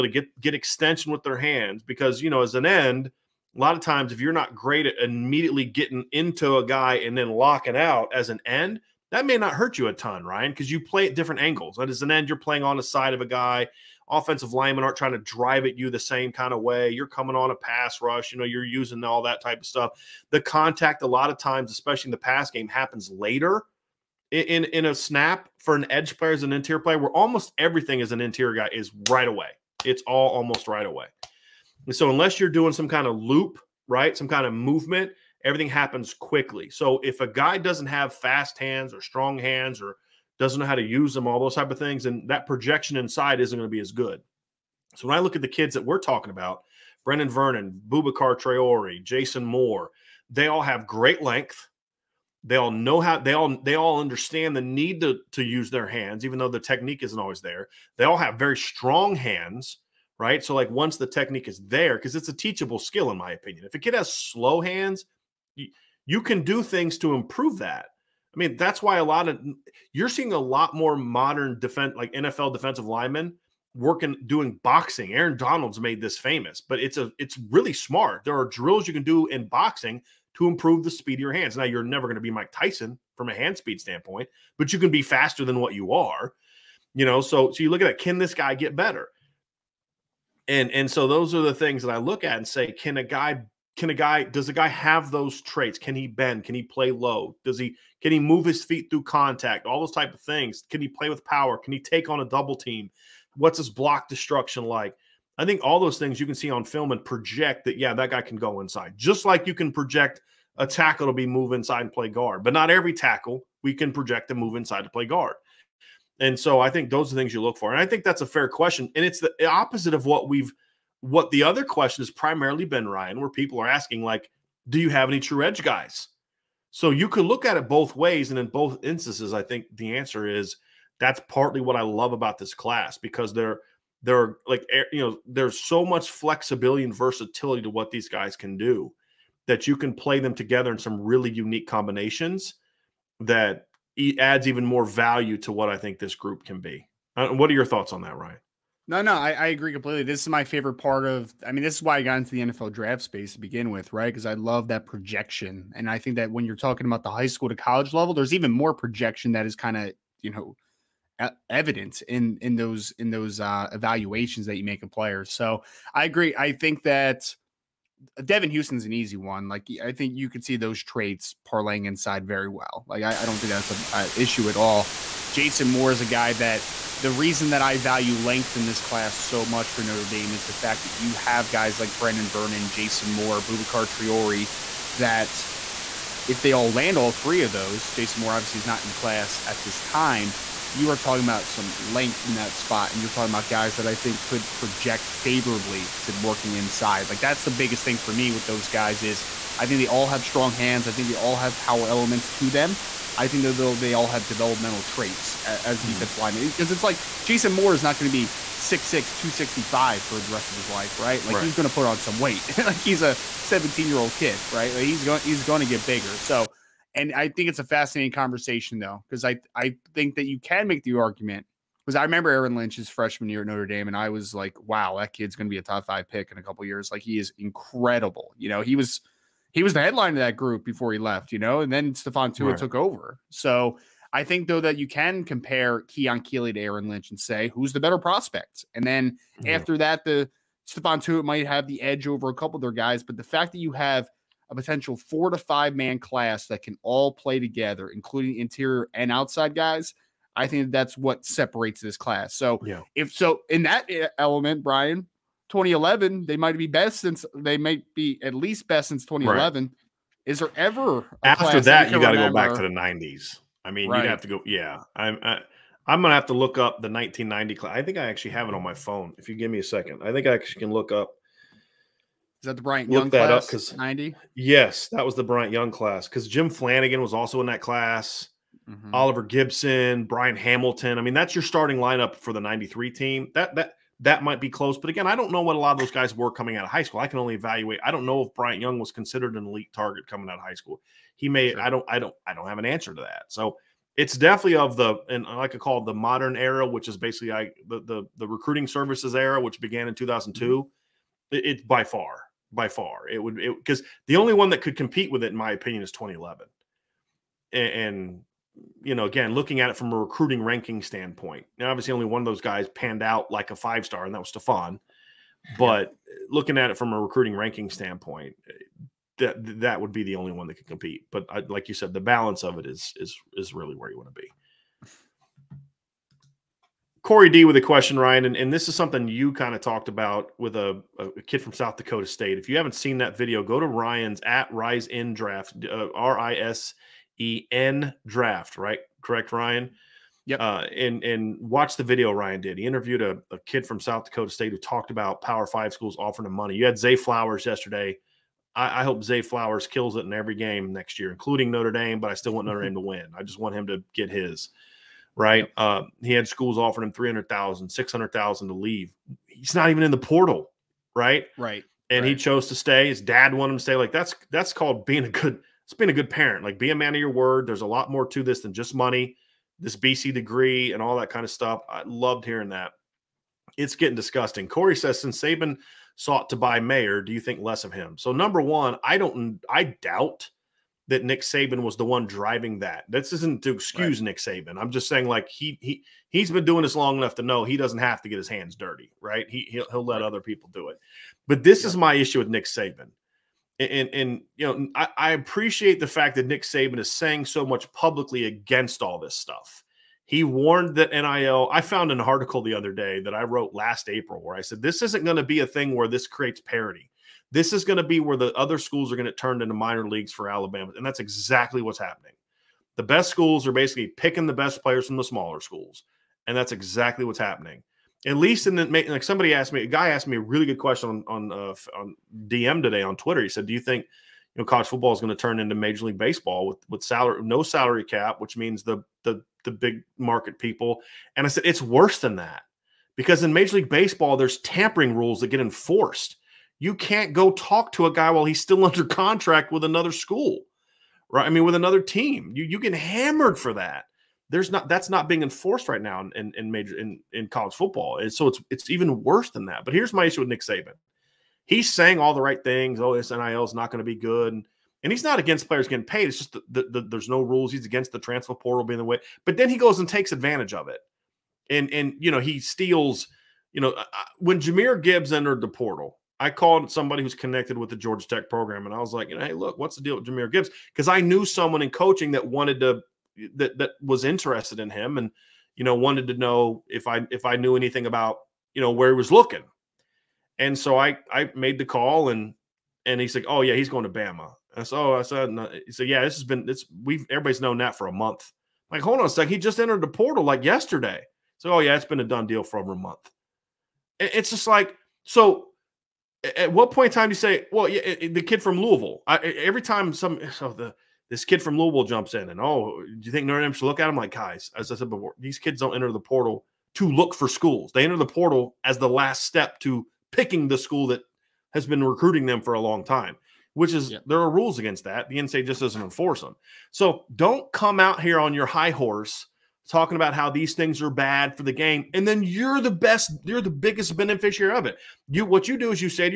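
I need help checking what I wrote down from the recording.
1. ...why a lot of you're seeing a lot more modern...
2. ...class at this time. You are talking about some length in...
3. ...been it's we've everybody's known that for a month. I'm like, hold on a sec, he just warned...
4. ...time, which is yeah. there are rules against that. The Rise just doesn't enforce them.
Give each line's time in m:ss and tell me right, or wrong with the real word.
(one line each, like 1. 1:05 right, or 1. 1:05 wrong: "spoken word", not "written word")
1. 1:08 right
2. 3:08 right
3. 8:06 wrong: "entered", not "warned"
4. 8:32 wrong: "NSA", not "Rise".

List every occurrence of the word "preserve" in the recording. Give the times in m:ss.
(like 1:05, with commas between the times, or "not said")
not said.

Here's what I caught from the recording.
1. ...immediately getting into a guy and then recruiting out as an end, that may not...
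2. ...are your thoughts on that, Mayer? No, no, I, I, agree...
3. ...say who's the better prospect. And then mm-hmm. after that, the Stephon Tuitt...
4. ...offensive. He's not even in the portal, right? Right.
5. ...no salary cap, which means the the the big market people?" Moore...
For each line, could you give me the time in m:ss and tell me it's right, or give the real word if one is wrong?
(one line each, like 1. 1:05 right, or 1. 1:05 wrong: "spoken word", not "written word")
1. 0:05 wrong: "locking", not "recruiting"
2. 2:27 wrong: "Ryan", not "Mayer"
3. 3:57 right
4. 5:58 wrong: "leave", not "offensive"
5. 7:07 wrong: "And", not "Moore".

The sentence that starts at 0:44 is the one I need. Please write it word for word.
So when I look at the kids that we're talking about, Brenan Vernon, Boubacar Traore, Jason Moore, they all have great length.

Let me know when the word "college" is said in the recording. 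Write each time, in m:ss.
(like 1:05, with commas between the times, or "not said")
2:37, 7:04, 7:27.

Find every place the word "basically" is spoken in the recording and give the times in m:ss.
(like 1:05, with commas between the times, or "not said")
4:56, 6:53.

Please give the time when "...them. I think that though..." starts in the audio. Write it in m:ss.
3:22.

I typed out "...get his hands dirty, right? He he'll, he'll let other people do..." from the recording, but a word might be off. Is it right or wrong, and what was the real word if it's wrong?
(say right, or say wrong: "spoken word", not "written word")
right.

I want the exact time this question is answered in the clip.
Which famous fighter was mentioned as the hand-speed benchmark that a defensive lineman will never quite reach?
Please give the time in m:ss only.
1:22.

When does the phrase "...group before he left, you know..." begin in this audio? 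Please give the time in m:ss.
3:50.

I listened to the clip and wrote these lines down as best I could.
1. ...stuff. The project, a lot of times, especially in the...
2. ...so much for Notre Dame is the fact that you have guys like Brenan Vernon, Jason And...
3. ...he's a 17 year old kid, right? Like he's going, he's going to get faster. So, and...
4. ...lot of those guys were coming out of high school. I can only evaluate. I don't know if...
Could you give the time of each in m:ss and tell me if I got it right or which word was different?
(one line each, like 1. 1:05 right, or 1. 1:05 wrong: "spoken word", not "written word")
1. 0:19 wrong: "contact", not "project"
2. 2:59 wrong: "Moore", not "And"
3. 3:32 wrong: "bigger", not "faster"
4. 4:45 right.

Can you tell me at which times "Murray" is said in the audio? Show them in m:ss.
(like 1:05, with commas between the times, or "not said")
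not said.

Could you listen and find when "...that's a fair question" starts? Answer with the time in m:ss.
1:58.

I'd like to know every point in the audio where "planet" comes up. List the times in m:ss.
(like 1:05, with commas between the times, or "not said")
not said.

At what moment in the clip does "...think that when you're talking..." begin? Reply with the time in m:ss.
2:35.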